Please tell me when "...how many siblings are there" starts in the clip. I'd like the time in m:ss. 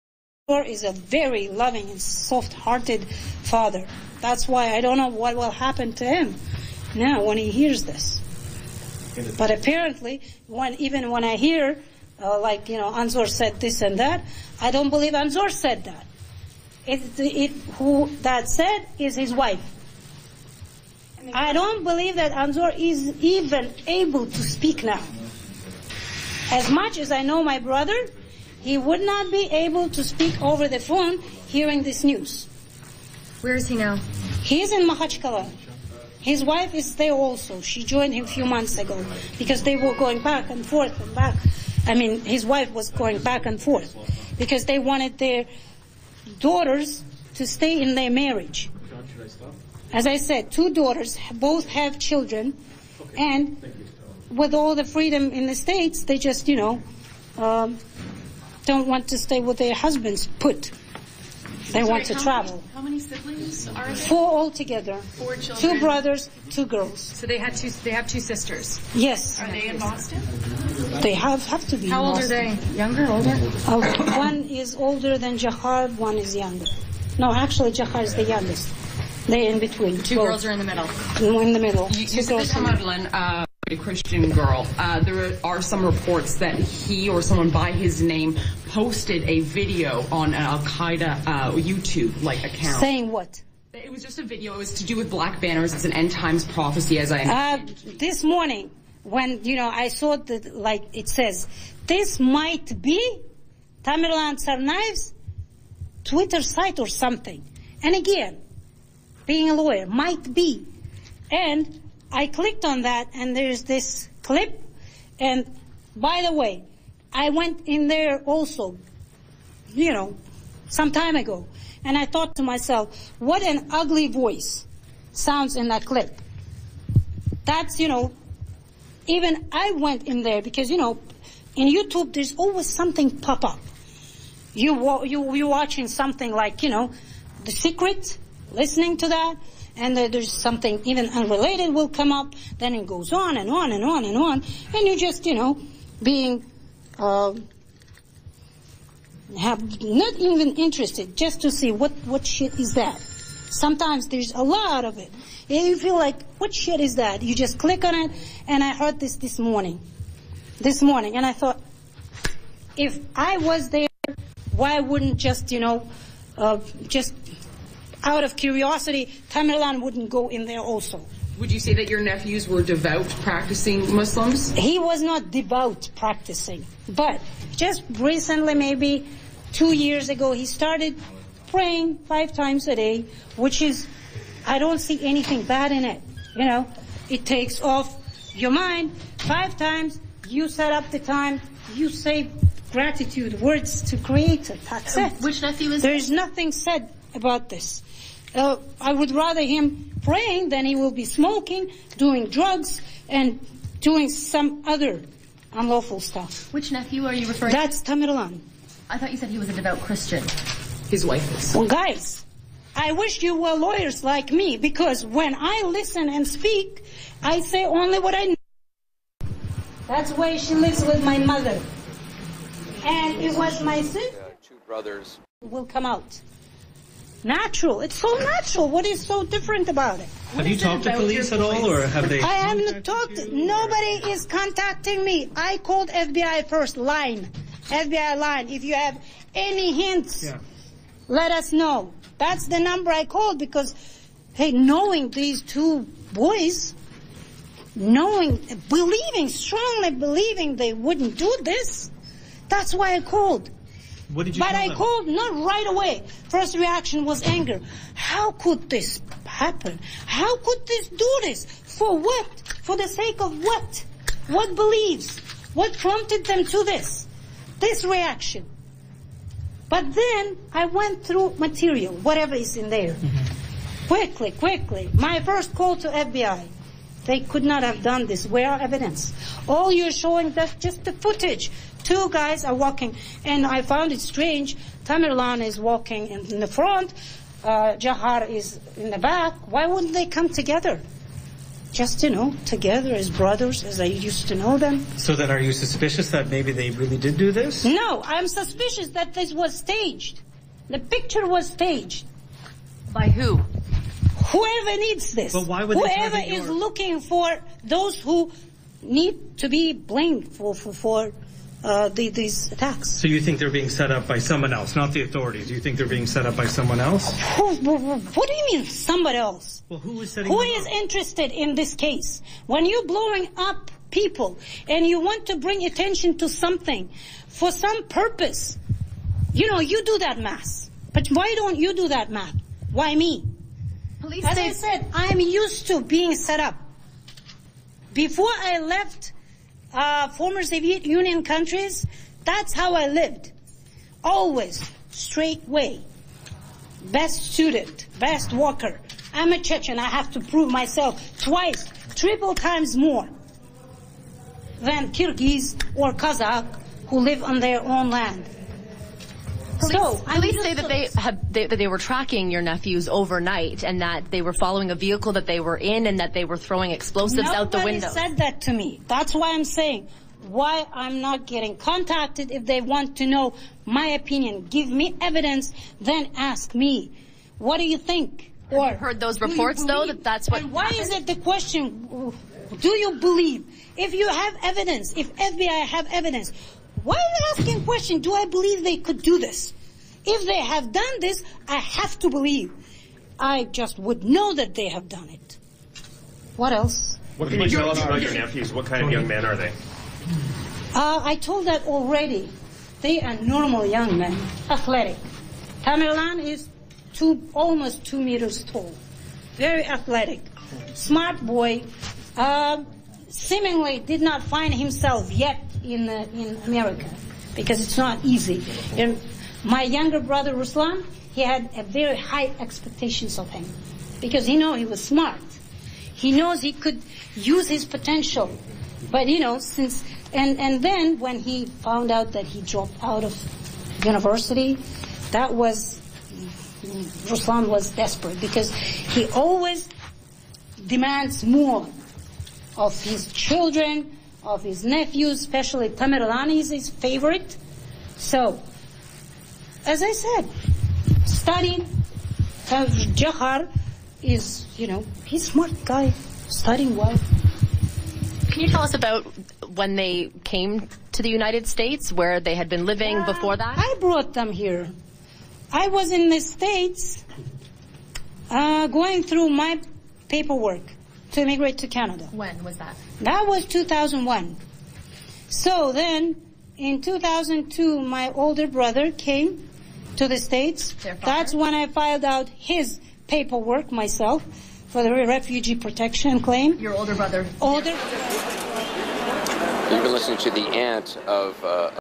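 1:02.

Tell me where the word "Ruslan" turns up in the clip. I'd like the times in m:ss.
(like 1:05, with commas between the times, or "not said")
7:00, 7:17.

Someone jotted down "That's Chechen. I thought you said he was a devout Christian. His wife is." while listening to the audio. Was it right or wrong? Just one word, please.
wrong.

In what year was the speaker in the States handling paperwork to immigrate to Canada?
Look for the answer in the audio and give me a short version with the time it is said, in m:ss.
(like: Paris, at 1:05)
2001, at 7:53.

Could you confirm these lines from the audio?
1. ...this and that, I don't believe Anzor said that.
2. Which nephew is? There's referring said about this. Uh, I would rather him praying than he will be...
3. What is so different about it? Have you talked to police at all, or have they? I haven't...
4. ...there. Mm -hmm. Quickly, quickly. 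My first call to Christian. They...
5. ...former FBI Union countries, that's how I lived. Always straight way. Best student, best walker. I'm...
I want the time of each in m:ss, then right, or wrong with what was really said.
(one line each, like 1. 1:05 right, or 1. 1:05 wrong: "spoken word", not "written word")
1. 0:13 right
2. 3:15 wrong: "nothing", not "referring"
3. 3:48 right
4. 4:32 wrong: "FBI", not "Christian"
5. 5:40 wrong: "Soviet", not "FBI".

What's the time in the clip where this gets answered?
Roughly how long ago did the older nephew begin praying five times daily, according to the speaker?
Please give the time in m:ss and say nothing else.
2:59.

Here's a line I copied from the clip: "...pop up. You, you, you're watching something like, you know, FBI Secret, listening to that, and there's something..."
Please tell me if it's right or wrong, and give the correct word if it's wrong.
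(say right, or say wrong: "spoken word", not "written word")
wrong: "The", not "FBI".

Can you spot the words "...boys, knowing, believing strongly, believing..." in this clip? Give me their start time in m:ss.
4:06.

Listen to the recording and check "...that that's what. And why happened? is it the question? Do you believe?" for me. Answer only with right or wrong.
right.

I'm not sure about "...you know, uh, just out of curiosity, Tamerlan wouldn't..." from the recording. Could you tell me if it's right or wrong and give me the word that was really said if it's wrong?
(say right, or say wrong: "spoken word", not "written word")
right.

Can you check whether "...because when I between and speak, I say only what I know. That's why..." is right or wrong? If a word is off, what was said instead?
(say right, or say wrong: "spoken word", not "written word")
wrong: "listen", not "between".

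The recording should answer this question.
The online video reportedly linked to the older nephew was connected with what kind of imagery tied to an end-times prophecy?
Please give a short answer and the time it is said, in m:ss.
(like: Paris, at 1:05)
black banners, at 1:35.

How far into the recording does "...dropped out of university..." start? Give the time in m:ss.
7:12.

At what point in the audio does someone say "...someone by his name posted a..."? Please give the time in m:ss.
1:27.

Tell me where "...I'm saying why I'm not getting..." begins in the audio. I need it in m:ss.
6:09.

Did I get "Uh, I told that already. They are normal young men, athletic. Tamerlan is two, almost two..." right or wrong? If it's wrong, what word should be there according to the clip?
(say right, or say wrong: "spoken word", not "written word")
right.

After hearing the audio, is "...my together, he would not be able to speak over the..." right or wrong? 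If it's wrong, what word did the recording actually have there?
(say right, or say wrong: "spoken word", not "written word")
wrong: "brother", not "together".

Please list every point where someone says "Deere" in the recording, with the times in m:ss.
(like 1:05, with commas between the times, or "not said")
not said.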